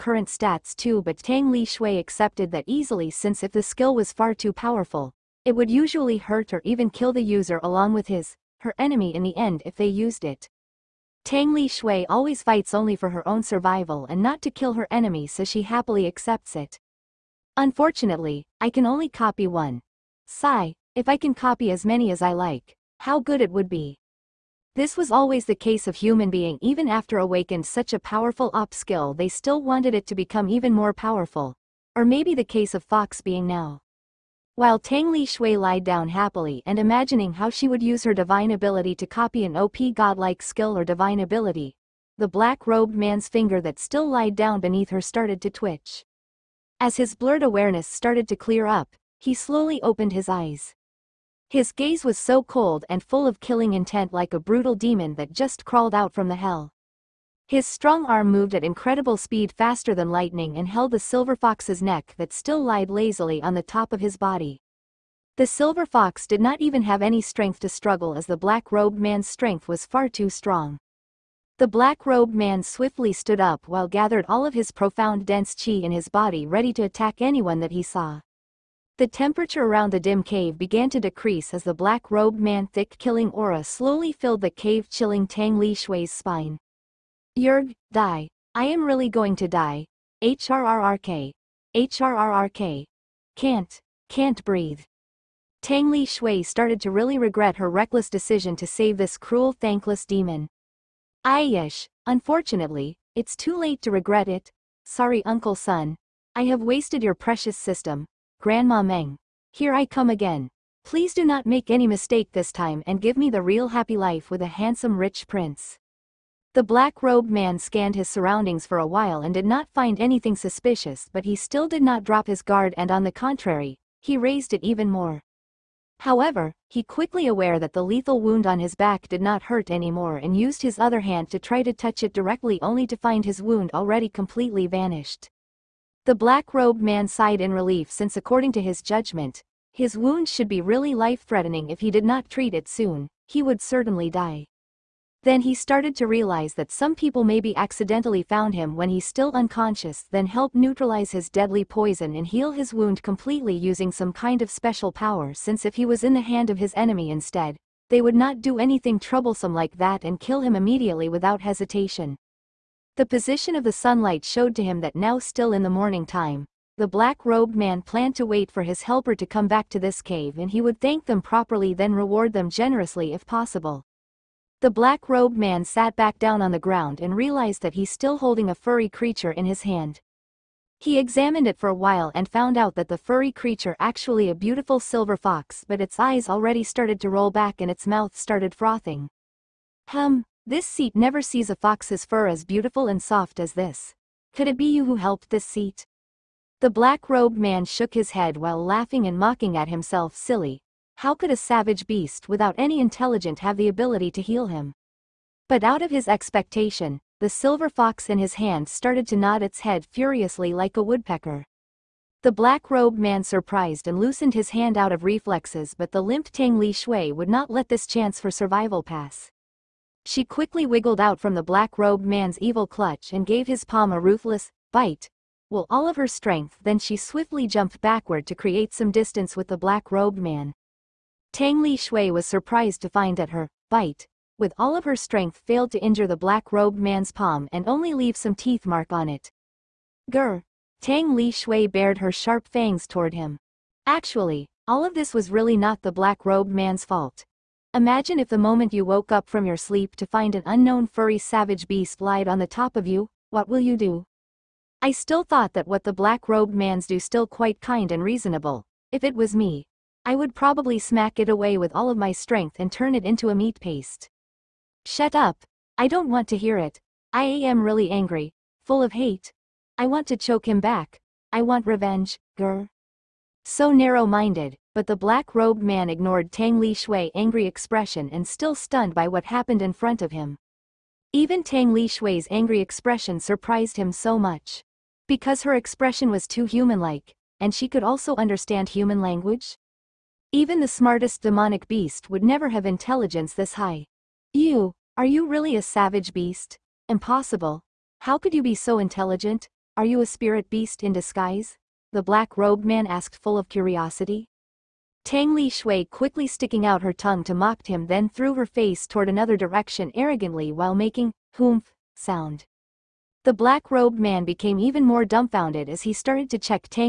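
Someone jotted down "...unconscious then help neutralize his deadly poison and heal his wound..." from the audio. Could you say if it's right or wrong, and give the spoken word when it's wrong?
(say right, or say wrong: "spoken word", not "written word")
right.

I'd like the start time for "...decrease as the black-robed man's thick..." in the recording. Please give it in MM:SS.
01:20.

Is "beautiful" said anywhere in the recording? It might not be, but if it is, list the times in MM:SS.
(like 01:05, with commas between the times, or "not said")
03:04, 03:12.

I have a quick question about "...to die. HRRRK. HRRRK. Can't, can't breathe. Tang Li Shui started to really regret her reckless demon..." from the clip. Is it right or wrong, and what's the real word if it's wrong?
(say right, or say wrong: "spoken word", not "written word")
wrong: "decision", not "demon".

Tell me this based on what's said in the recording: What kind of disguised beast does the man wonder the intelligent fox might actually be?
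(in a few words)
Spirit beast.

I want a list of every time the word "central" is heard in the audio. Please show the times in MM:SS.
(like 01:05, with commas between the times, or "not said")
not said.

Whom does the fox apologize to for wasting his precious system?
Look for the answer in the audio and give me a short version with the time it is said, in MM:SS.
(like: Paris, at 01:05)
Uncle Sun, at 01:45.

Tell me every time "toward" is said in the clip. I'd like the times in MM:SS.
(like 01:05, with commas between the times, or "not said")
04:02, 05:08.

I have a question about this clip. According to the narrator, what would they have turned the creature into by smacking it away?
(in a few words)
Meat paste.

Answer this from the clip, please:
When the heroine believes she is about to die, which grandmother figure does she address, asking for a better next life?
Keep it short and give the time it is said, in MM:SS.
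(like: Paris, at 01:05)
Grandma Meng, at 01:48.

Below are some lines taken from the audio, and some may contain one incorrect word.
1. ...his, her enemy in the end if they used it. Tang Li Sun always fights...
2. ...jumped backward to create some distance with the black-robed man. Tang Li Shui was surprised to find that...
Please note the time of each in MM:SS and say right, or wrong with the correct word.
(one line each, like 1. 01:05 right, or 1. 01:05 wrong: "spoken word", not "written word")
1. 00:08 wrong: "Shui", not "Sun"
2. 03:47 right.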